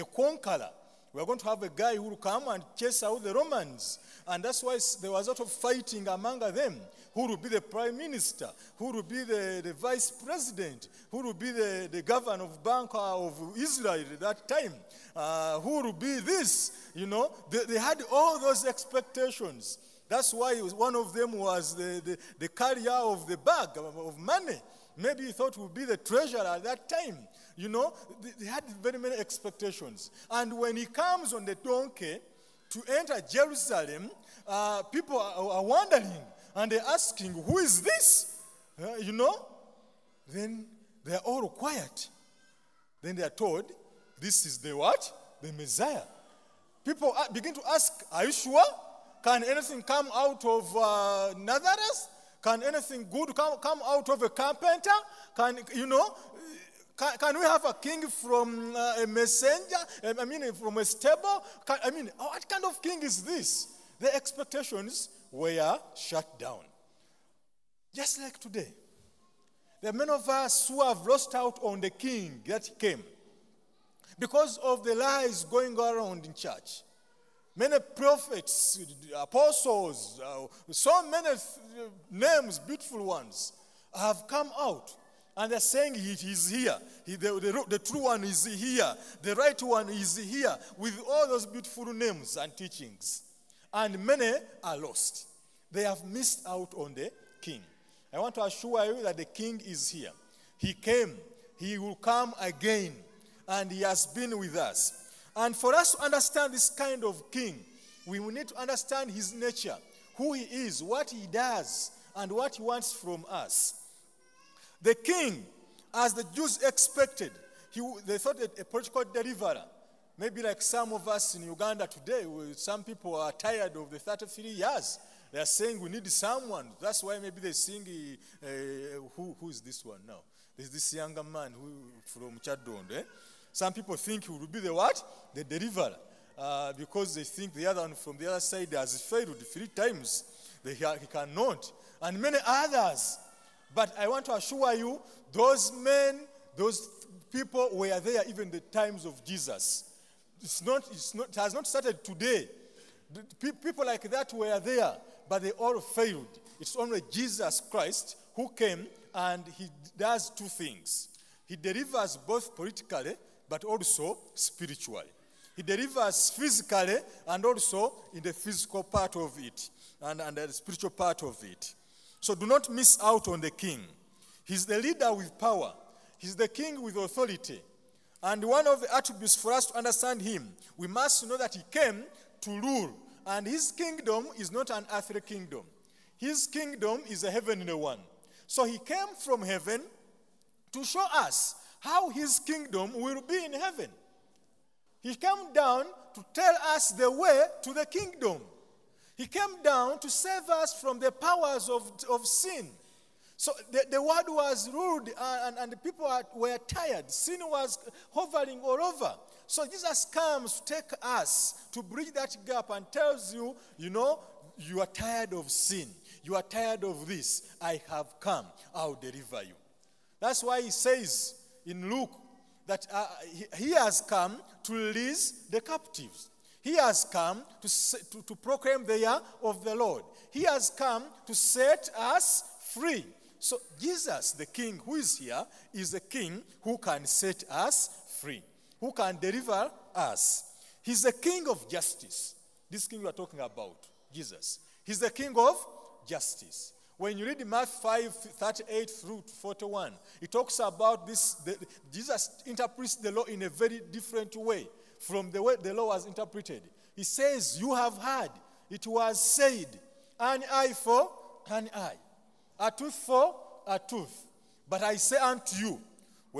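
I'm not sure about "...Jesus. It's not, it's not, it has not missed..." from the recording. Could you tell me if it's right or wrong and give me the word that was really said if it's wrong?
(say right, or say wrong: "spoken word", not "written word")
wrong: "started", not "missed".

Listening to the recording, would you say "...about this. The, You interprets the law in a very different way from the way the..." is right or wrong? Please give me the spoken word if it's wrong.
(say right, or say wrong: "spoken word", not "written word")
wrong: "Jesus", not "You".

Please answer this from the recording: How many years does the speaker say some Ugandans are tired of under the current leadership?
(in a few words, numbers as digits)
33.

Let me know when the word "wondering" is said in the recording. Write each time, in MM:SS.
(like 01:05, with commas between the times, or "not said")
00:35.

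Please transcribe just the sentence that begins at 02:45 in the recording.
He delivers physically and also in the physical part of it and, and the spiritual part of it.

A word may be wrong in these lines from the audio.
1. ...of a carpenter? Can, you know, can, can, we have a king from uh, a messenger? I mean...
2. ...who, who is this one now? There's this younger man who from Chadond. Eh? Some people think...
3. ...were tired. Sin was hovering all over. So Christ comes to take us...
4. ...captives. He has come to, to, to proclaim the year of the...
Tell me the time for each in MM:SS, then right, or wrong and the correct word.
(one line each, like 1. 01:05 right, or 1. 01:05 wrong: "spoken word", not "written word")
1. 00:54 right
2. 02:09 right
3. 03:26 wrong: "Jesus", not "Christ"
4. 03:45 right.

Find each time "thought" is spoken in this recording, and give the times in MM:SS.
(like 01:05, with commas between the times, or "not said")
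00:25, 01:58.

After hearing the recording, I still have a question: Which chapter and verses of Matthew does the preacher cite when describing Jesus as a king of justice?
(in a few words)
Matthew 5:38-41.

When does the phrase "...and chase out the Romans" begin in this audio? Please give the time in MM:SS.
00:02.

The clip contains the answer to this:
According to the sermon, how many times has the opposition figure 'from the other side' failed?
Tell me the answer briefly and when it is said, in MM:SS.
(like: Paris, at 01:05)
Three times, at 02:19.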